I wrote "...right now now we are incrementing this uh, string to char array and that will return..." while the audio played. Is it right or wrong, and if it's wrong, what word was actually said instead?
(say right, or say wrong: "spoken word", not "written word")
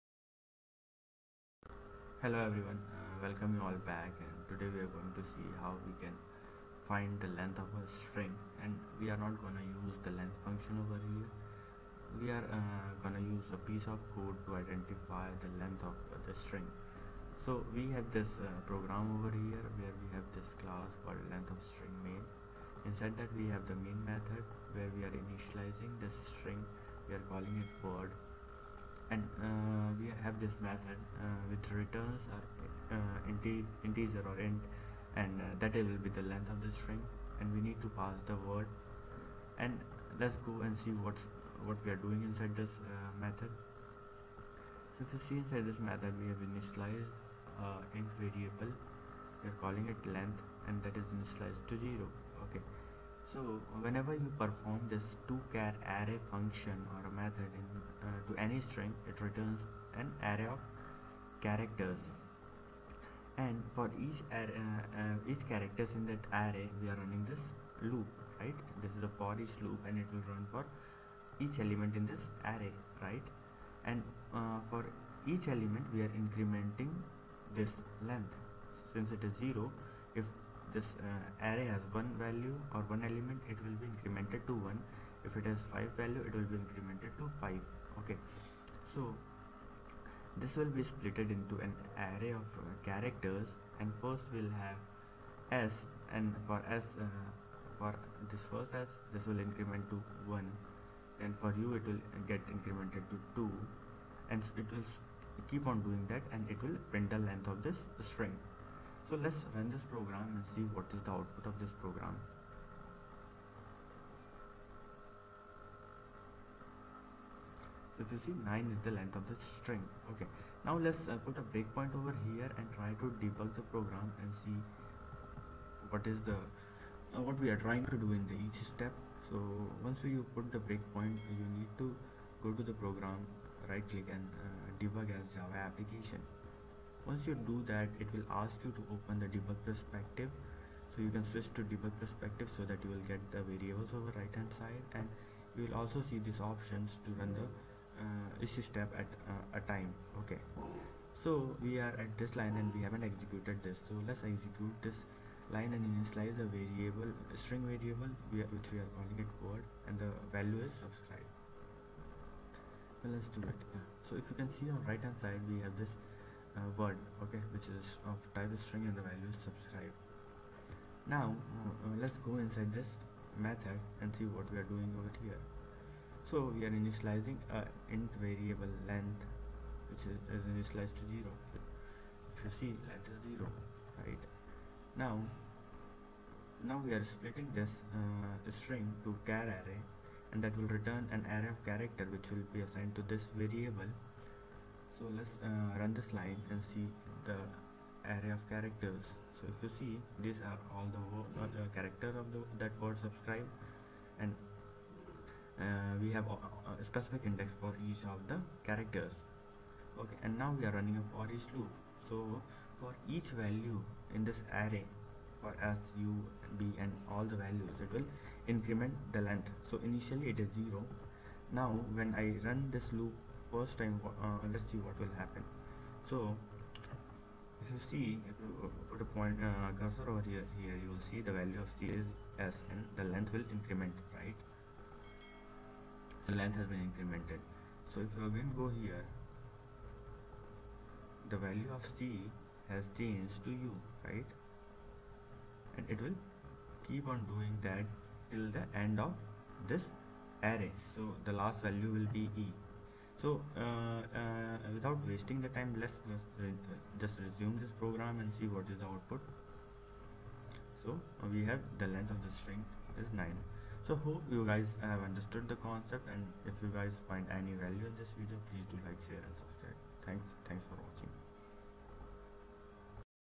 wrong: "splitting", not "incrementing".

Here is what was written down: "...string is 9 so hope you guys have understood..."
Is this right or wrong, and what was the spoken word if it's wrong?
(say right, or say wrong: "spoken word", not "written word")
right.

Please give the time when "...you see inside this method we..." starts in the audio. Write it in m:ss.
0:45.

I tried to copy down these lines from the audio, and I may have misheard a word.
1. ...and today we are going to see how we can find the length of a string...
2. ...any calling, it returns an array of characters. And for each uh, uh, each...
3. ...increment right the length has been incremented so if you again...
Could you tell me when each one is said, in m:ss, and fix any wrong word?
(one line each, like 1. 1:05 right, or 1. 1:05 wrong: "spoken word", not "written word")
1. 0:04 right
2. 0:58 wrong: "string", not "calling"
3. 3:53 right.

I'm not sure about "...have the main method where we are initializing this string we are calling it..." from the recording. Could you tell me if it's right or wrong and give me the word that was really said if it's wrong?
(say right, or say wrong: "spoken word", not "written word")
right.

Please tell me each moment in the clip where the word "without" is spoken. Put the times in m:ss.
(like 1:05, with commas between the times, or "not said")
4:14.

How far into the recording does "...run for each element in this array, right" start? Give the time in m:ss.
1:10.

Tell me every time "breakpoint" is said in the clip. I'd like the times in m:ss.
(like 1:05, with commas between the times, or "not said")
2:01, 2:10.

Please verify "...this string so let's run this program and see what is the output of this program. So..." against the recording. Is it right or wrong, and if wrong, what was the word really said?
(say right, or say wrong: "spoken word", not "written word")
right.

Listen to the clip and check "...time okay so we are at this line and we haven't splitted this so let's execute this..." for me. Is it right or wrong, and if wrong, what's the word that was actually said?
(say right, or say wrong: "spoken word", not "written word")
wrong: "executed", not "splitted".